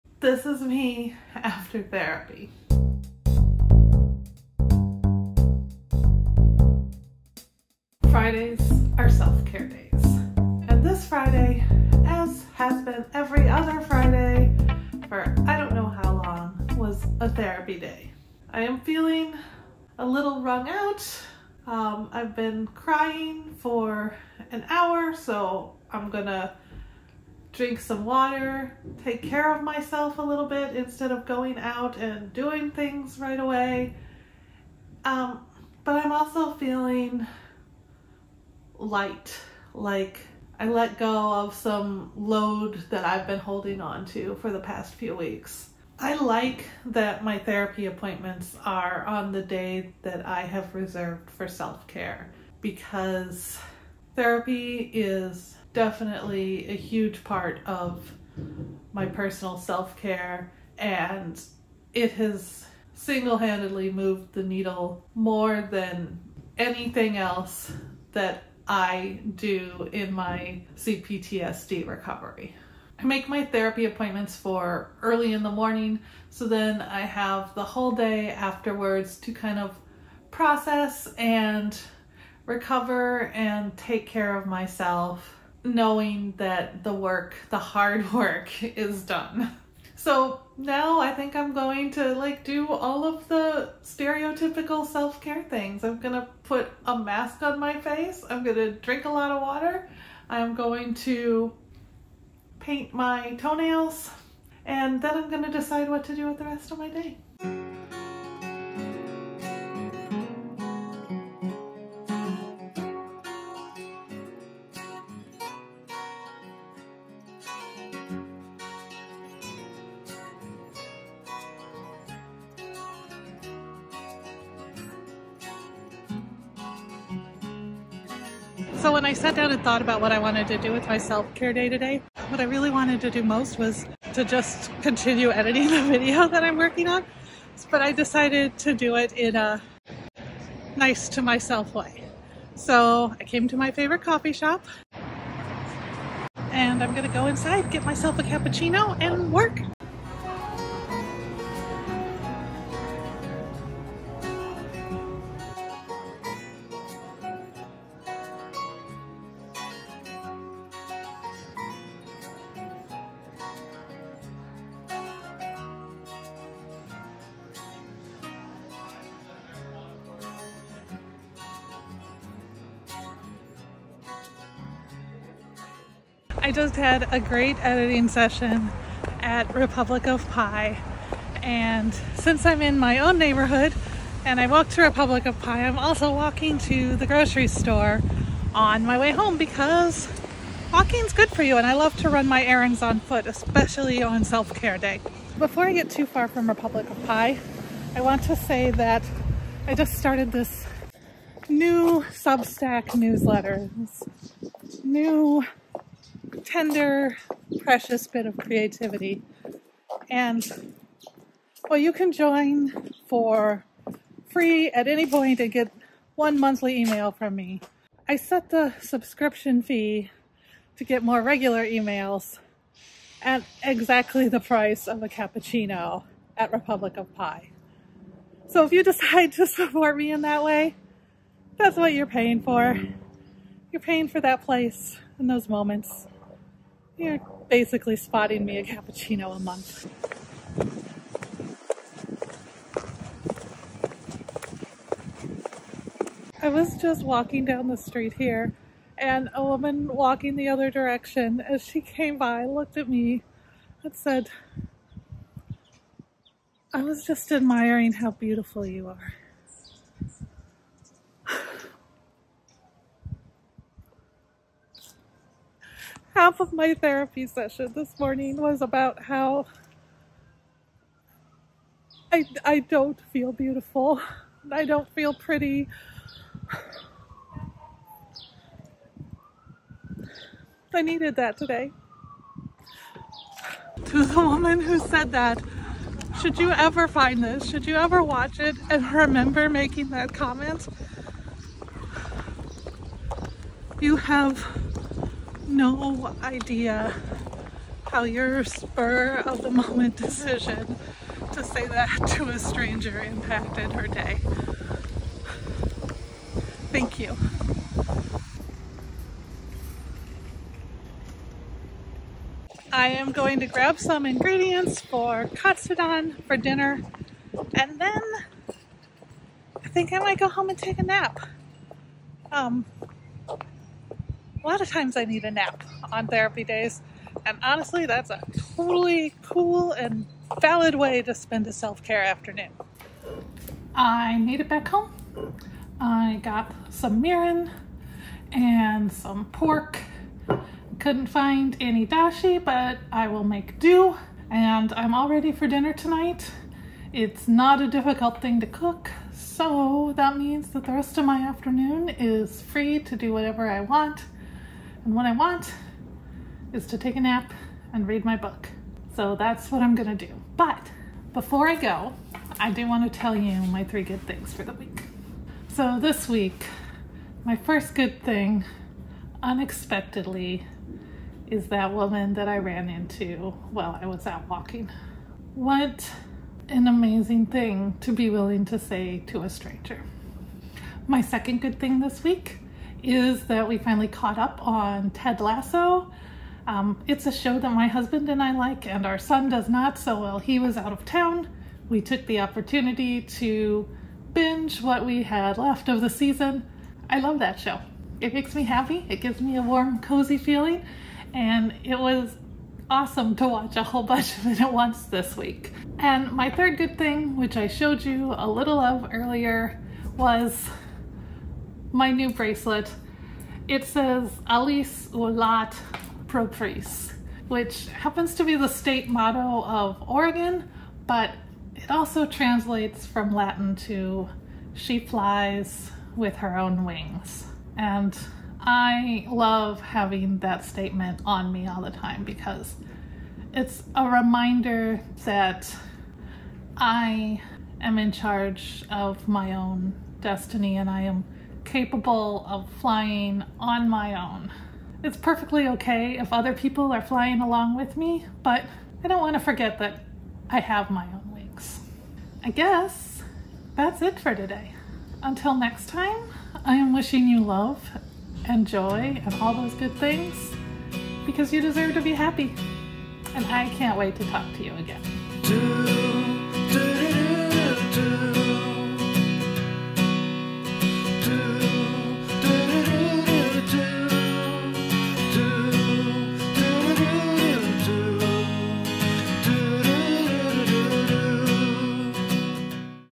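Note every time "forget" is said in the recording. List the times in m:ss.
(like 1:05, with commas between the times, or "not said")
7:29.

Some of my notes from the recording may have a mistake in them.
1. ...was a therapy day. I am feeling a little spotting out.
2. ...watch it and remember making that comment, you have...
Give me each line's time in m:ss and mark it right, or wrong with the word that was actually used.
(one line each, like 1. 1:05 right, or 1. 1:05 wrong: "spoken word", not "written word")
1. 0:16 wrong: "wrung", not "spotting"
2. 4:48 right.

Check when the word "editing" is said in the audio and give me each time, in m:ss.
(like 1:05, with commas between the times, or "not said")
2:15, 2:57.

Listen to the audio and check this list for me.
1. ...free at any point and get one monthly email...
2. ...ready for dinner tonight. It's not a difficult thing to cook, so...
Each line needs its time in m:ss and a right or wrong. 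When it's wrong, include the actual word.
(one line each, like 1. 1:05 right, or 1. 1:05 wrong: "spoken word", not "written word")
1. 3:34 right
2. 5:45 right.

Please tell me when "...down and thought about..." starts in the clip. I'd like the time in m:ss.
2:09.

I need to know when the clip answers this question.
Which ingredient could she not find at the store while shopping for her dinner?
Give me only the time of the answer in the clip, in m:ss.
5:40.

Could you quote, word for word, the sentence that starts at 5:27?
And honestly, that's a totally cool and valid way to spend a self-care afternoon.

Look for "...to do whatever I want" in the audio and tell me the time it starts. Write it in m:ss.
5:52.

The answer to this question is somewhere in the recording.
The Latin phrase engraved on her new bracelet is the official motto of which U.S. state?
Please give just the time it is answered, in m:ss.
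6:59.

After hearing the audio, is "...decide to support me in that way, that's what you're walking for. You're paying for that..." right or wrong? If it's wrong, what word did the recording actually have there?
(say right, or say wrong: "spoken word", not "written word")
wrong: "paying", not "walking".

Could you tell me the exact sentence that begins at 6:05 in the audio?
So this week, my first good thing, unexpectedly, is that woman that I ran into while I was out walking.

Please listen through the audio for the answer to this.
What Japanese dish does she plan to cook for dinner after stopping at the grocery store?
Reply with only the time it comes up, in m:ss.
5:15.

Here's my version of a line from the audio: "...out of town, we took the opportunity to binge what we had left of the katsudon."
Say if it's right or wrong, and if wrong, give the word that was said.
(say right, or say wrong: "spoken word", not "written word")
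wrong: "season", not "katsudon".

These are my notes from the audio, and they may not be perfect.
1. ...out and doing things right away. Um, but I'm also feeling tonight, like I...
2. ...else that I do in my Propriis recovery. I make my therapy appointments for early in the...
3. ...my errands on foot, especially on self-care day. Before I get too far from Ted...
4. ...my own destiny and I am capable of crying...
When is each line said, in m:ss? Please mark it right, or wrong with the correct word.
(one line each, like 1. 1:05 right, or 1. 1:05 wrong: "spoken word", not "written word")
1. 0:31 wrong: "light", not "tonight"
2. 1:07 wrong: "CPTSD", not "Propriis"
3. 3:12 wrong: "Republic", not "Ted"
4. 7:19 wrong: "flying", not "crying".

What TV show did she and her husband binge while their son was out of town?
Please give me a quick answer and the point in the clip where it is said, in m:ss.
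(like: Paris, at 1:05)
Ted Lasso, at 6:24.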